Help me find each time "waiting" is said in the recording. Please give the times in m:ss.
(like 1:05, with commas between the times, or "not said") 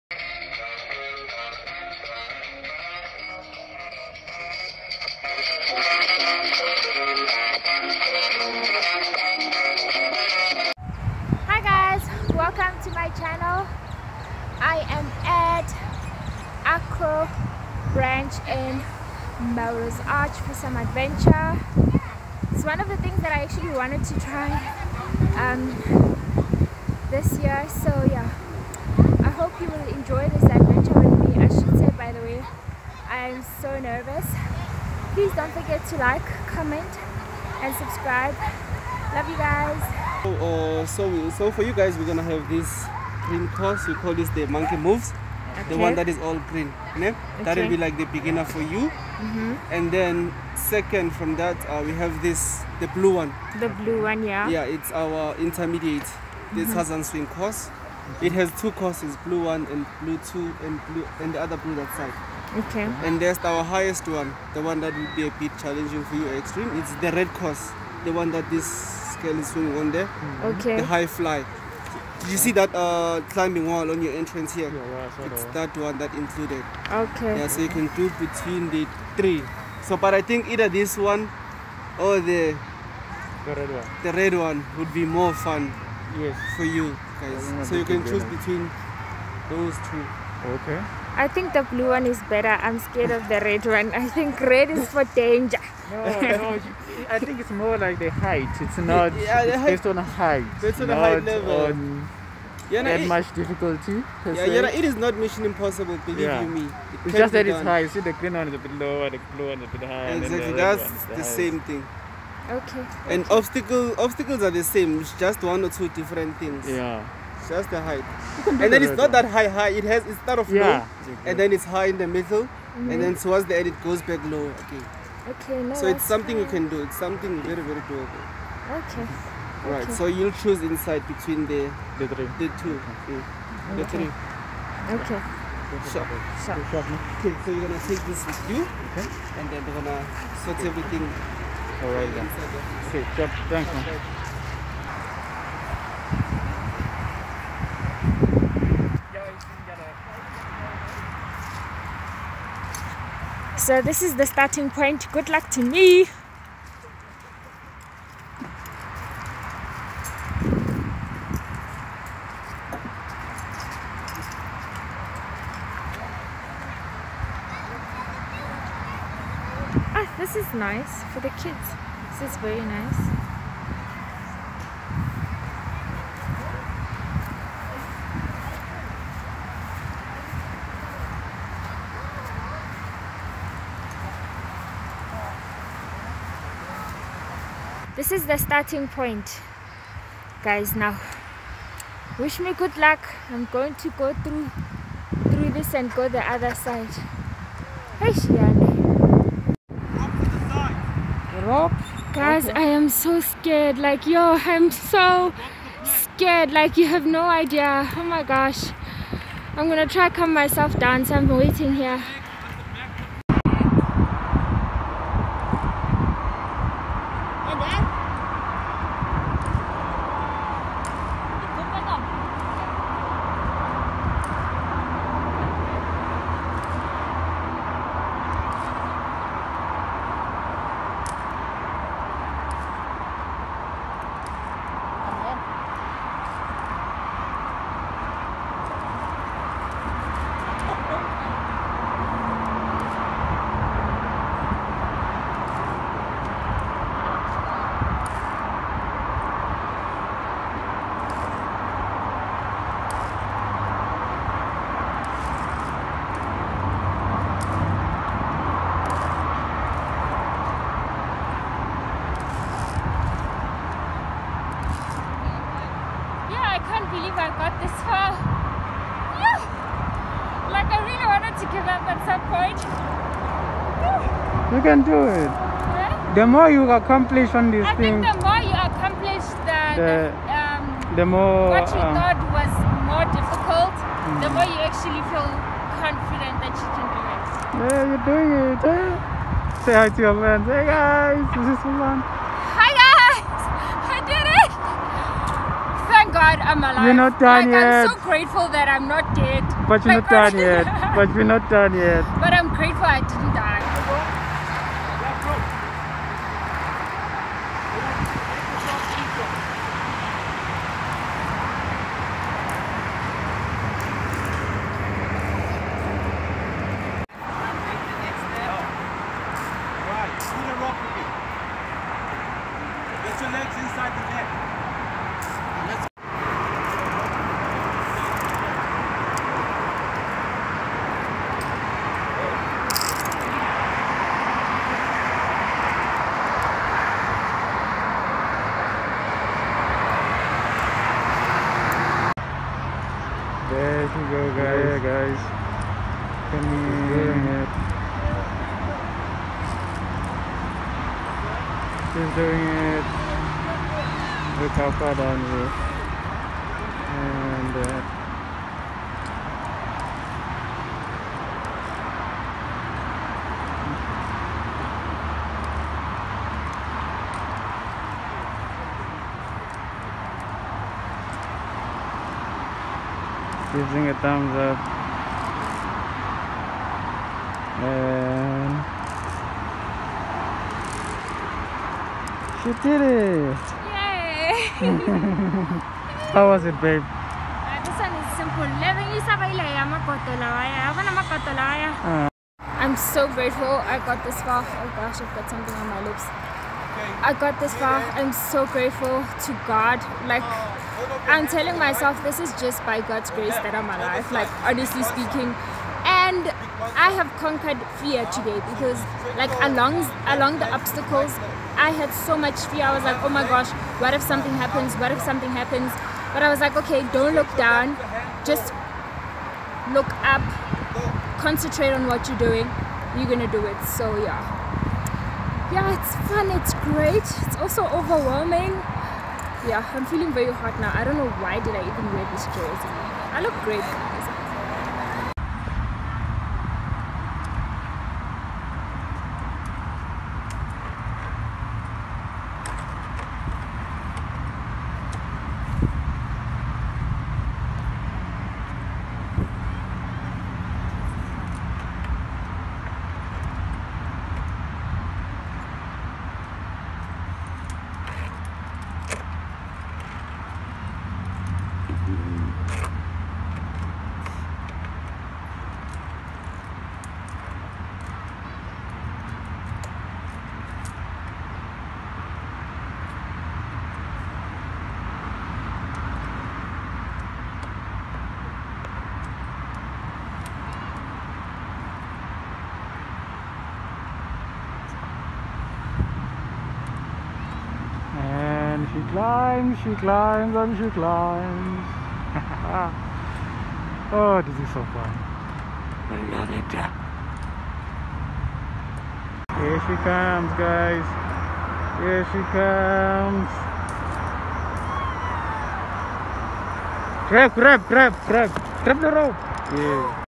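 3:31.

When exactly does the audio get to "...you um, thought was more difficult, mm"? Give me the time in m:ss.
4:41.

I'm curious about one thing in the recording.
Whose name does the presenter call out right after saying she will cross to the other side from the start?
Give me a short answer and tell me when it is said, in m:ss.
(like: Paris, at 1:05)
Shiane, at 3:18.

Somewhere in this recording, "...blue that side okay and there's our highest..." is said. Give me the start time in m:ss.
1:01.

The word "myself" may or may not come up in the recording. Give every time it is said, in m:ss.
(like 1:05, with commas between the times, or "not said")
3:30, 6:41.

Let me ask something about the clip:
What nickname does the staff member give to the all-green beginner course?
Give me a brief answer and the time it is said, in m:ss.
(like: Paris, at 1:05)
monkey moves, at 0:44.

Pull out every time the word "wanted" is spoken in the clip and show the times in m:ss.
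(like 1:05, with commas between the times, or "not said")
0:23, 4:31.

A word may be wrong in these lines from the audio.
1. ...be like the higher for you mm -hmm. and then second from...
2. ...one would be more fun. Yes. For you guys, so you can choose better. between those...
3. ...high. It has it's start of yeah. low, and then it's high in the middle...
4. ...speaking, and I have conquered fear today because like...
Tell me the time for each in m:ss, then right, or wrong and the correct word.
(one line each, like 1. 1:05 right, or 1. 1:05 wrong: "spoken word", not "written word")
1. 0:47 wrong: "beginner", not "higher"
2. 1:24 right
3. 1:59 right
4. 6:44 right.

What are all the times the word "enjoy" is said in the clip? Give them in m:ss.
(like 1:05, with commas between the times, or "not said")
0:29.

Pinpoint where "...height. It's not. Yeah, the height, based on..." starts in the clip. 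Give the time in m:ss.
1:38.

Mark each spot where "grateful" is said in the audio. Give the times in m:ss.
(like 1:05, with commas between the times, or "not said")
4:58, 5:02, 6:33, 6:38.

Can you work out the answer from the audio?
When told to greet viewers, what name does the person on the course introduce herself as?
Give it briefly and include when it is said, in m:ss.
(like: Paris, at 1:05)
Sulan, at 4:51.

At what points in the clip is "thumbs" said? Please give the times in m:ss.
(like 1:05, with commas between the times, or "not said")
6:13.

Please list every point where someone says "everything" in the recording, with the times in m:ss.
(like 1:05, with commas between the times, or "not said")
2:20.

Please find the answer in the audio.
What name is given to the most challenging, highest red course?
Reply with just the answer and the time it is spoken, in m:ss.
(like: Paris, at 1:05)
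the high fly, at 1:10.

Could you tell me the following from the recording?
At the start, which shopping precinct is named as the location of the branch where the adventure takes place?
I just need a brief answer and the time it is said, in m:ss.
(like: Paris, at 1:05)
Melrose Arch, at 0:19.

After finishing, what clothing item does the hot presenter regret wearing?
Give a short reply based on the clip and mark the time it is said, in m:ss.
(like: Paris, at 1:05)
jersey, at 7:12.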